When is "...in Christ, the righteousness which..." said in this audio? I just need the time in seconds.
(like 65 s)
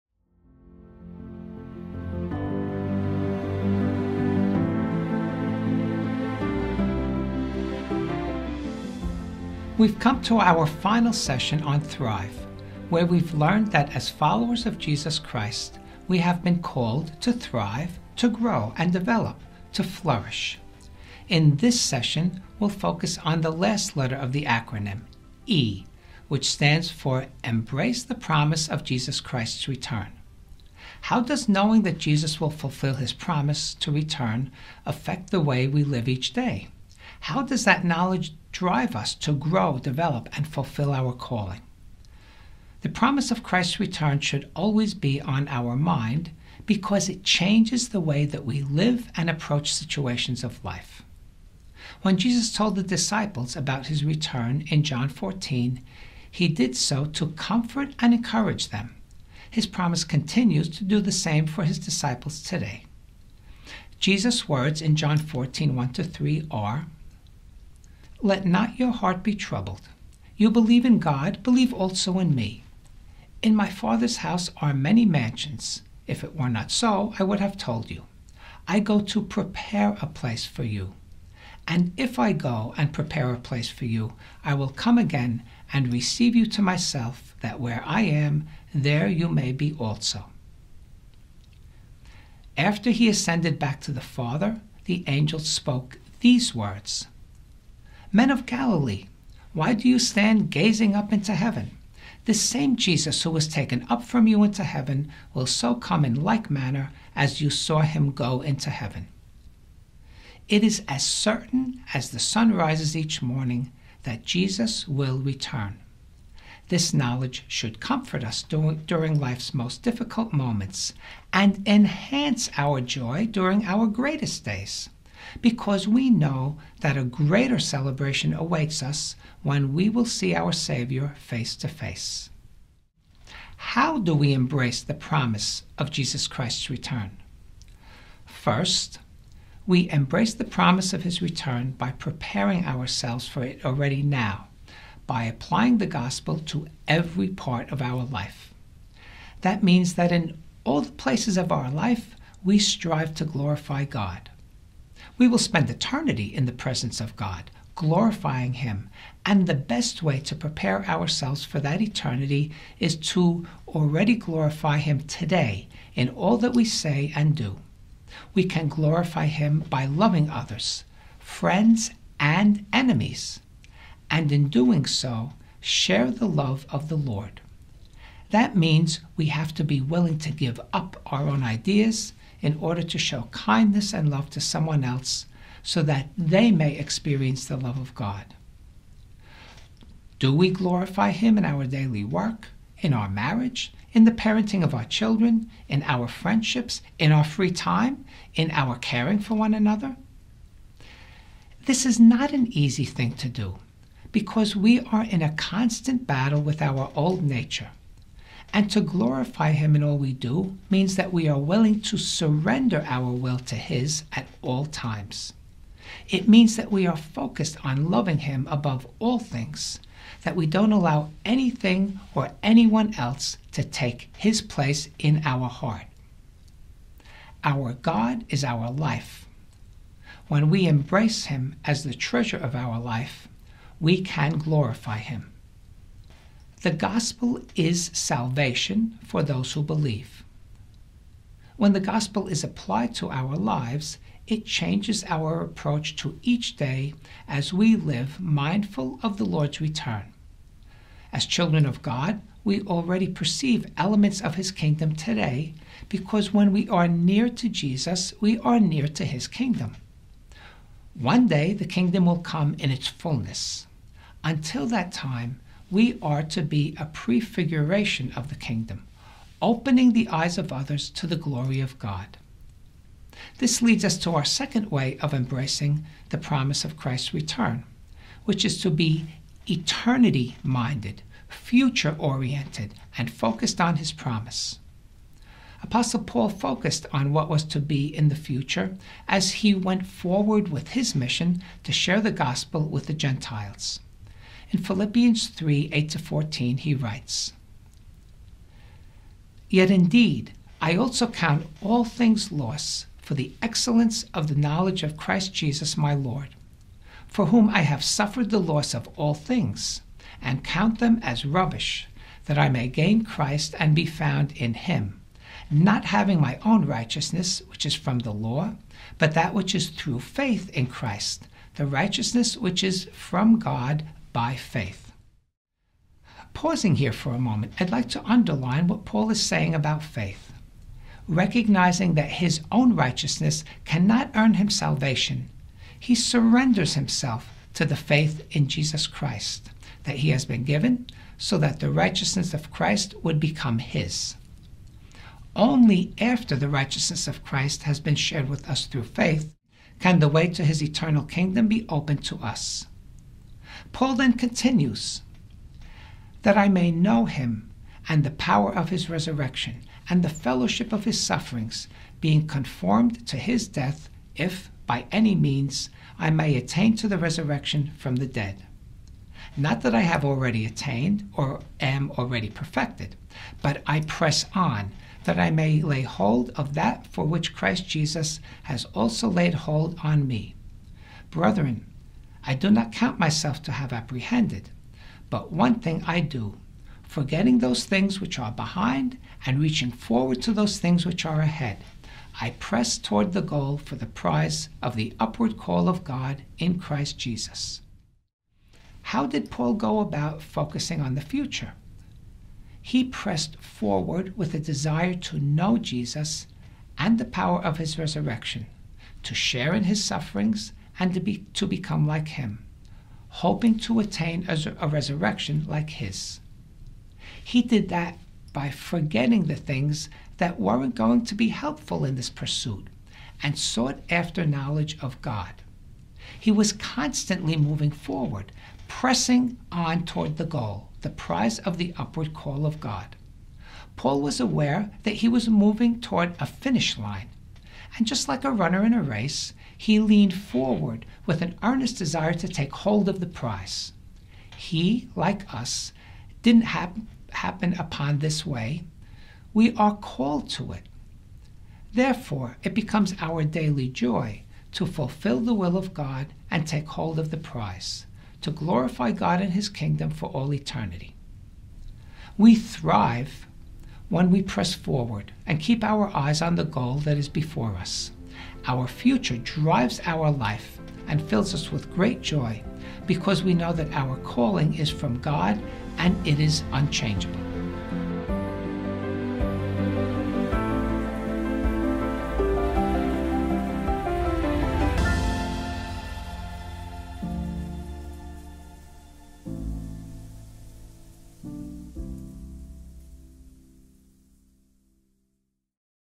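320 s.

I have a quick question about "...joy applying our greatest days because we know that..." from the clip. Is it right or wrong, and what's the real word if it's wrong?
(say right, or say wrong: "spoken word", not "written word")
wrong: "during", not "applying".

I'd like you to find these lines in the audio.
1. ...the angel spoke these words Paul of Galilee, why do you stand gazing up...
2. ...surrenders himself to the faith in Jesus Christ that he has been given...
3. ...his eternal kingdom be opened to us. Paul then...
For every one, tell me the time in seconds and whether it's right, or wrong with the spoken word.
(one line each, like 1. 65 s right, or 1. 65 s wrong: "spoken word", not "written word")
1. 94 s wrong: "Men", not "Paul"
2. 335 s right
3. 350 s right.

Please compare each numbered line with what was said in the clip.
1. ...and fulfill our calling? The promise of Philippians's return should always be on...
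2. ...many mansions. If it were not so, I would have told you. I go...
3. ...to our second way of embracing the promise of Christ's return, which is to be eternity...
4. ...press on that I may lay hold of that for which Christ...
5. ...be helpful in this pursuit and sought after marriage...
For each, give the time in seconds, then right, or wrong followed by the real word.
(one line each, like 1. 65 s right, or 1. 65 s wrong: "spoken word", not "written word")
1. 40 s wrong: "Christ", not "Philippians"
2. 74 s right
3. 273 s right
4. 373 s right
5. 421 s wrong: "knowledge", not "marriage".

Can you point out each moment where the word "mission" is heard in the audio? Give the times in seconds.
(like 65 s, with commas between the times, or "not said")
290 s.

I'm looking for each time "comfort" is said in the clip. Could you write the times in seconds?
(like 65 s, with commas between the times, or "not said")
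57 s, 117 s.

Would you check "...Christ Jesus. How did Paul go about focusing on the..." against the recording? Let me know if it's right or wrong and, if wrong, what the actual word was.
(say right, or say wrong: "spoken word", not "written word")
right.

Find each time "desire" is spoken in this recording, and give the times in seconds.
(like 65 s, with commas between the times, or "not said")
404 s, 441 s.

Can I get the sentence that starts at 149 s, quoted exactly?
That means that in all the places of our life, we strive to glorify God.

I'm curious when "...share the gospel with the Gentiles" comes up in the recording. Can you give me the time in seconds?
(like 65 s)
291 s.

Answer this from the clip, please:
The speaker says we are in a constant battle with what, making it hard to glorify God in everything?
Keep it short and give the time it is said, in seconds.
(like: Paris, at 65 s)
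our old nature, at 206 s.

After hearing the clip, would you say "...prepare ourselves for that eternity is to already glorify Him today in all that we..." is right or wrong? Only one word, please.
right.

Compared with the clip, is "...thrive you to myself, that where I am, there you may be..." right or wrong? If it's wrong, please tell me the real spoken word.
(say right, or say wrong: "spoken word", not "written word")
wrong: "receive", not "thrive".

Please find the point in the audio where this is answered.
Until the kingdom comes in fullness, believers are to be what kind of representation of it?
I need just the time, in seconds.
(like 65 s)
266 s.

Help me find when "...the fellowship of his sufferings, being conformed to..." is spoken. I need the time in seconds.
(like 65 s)
360 s.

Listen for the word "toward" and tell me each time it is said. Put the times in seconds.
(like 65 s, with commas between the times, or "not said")
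392 s, 429 s, 435 s.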